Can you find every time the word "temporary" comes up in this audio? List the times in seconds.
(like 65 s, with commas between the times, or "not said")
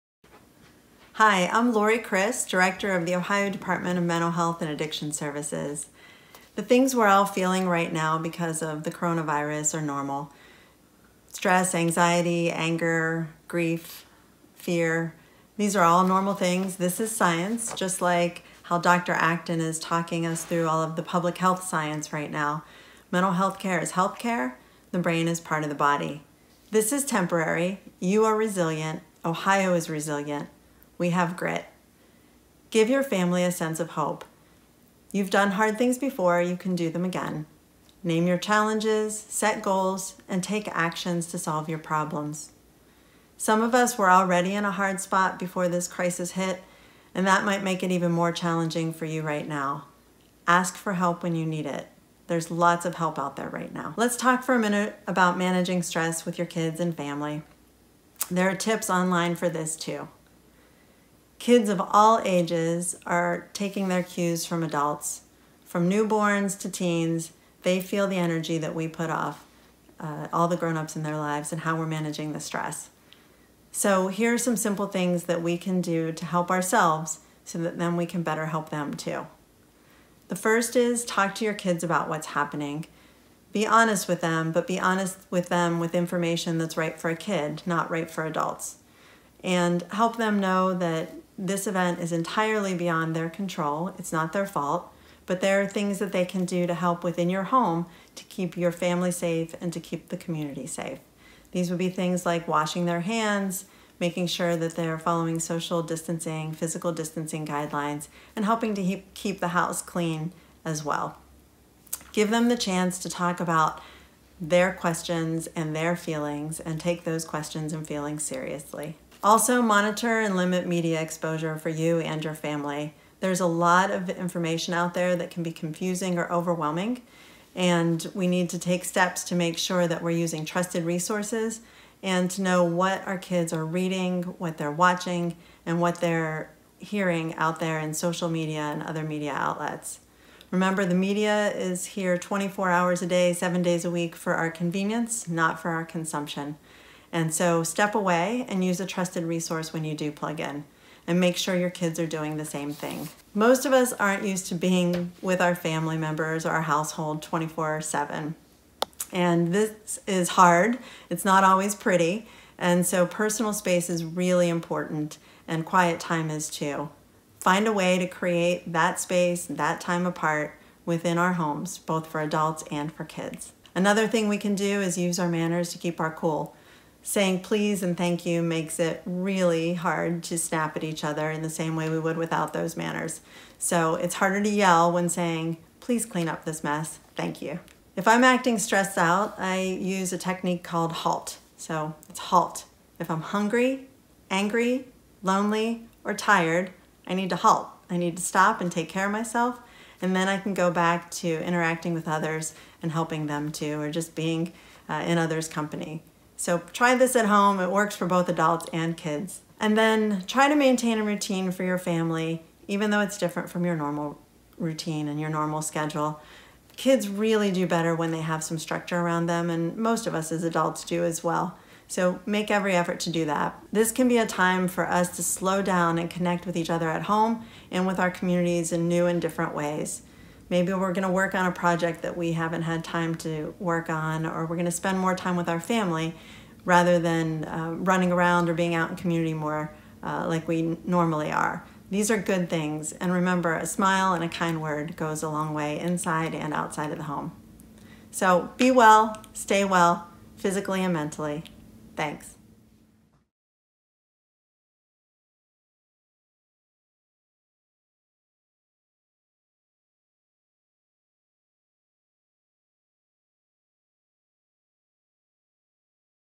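27 s.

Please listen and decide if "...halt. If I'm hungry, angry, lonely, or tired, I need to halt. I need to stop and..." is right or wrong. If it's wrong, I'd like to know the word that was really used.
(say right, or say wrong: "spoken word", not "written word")
right.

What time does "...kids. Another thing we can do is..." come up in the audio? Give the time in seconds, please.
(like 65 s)
173 s.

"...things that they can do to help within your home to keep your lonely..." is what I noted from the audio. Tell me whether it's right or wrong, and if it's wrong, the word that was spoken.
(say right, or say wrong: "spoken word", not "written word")
wrong: "family", not "lonely".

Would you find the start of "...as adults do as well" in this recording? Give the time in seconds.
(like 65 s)
220 s.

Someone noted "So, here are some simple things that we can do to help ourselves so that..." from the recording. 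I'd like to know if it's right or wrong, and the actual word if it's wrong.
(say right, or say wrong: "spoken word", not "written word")
right.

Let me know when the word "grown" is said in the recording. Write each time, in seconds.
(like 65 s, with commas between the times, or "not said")
70 s.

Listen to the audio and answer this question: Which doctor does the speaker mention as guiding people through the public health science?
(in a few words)
Dr. Acton.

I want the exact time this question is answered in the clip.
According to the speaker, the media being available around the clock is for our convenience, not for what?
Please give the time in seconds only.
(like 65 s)
145 s.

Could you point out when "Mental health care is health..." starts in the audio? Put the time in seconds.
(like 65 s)
23 s.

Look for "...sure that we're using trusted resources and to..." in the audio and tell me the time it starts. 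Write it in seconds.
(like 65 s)
129 s.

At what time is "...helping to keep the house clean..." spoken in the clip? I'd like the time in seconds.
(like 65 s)
108 s.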